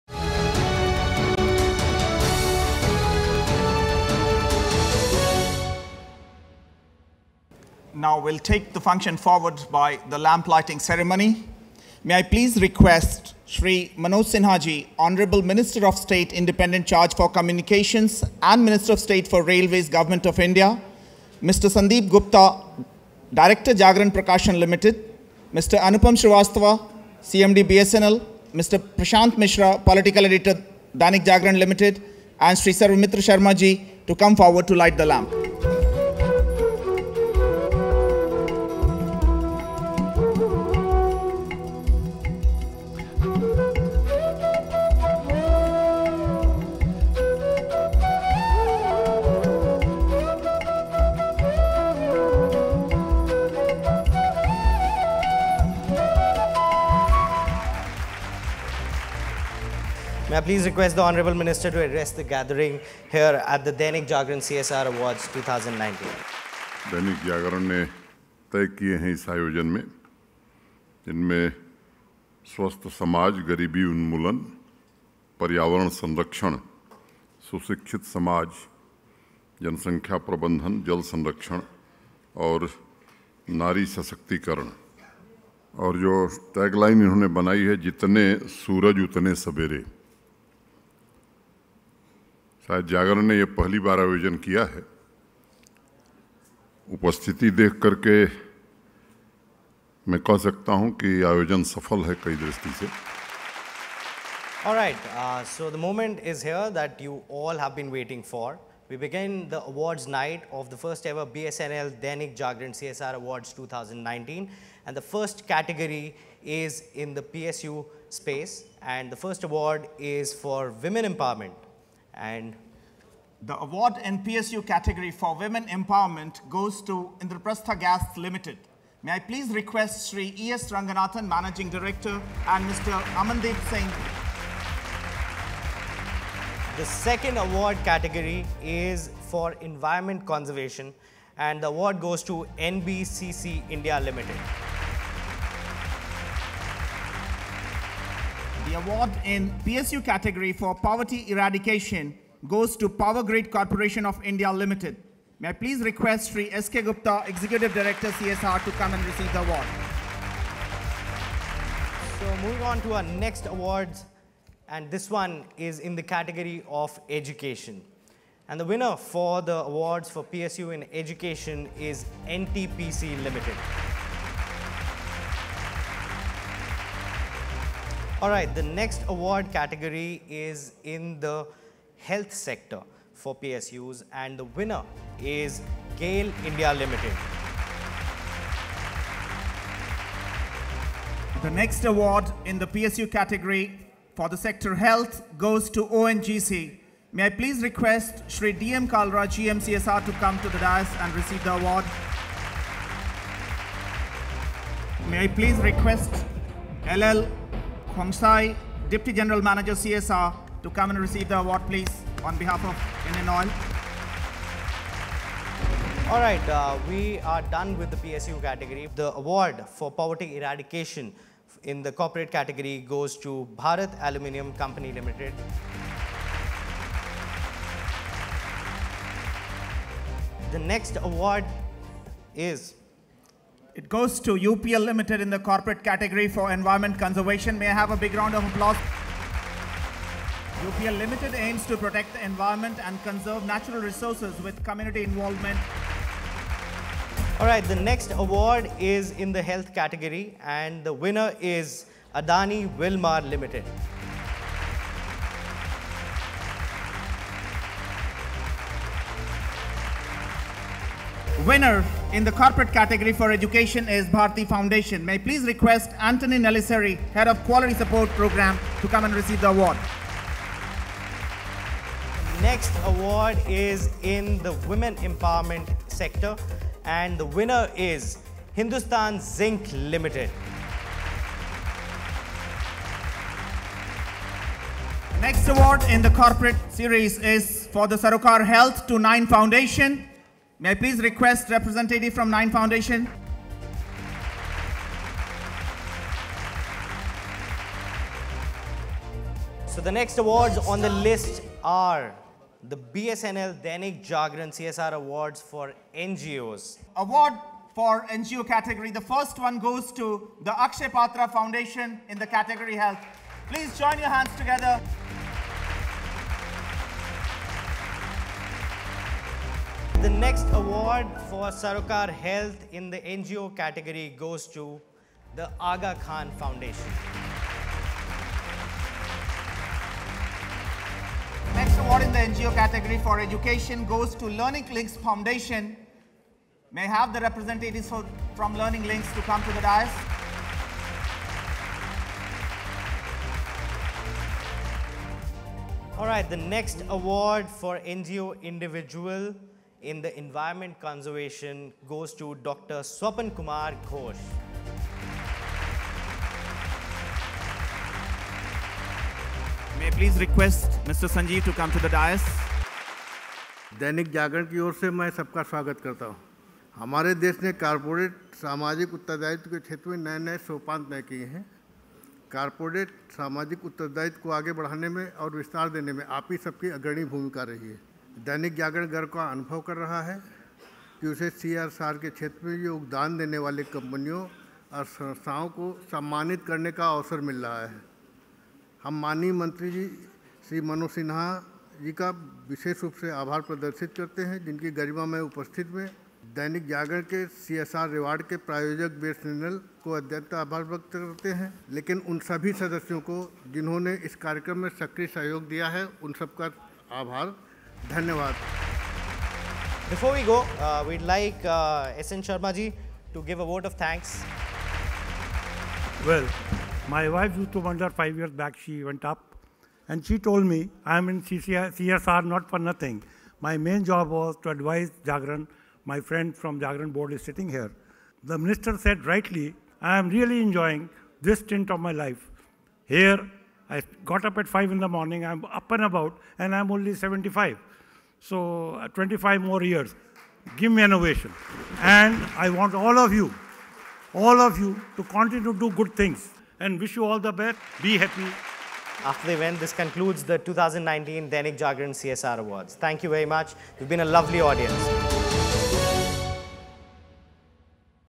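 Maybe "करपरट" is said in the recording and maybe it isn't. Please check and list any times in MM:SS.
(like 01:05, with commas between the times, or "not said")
06:07, 06:12.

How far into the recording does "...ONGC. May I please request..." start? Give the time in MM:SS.
03:15.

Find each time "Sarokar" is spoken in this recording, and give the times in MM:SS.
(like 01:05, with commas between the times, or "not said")
04:47, 05:21.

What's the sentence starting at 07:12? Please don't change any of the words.
Here, I got up at 5 in the morning, I'm up and about, and I'm only 75.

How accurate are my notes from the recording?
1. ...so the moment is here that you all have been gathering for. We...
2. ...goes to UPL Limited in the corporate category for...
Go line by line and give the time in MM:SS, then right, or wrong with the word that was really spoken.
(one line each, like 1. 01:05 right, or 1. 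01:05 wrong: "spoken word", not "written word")
1. 01:45 wrong: "waiting", not "gathering"
2. 03:53 right.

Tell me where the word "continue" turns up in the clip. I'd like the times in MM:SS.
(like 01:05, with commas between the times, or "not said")
07:25.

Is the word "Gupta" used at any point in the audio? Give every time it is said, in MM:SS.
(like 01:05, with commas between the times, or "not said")
00:22, 02:36.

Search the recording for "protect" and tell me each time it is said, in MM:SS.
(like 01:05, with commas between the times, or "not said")
04:01.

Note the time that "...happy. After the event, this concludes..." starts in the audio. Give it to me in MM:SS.
07:27.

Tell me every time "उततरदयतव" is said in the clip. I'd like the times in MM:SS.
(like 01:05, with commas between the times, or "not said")
06:08, 06:13.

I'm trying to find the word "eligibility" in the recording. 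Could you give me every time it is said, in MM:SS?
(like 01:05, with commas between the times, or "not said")
not said.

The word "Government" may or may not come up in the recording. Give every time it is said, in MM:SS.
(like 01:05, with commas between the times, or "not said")
00:19.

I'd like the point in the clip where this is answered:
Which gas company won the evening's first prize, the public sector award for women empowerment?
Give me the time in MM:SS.
02:07.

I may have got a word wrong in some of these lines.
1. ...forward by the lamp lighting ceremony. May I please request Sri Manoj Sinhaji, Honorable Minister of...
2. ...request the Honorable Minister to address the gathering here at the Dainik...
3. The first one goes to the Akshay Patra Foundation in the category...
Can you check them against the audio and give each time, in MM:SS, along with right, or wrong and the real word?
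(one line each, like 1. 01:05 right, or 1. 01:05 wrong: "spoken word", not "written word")
1. 00:09 right
2. 01:00 right
3. 05:08 right.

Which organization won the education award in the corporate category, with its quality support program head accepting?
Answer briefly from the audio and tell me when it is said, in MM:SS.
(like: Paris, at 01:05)
Bharti Foundation, at 04:24.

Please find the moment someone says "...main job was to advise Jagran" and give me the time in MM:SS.
07:03.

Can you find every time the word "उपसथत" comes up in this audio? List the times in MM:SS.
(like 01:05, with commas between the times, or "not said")
01:36, 06:35.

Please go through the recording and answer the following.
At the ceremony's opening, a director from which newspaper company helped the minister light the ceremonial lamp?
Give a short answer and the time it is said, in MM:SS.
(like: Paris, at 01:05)
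Jagran Prakashan Limited, at 00:23.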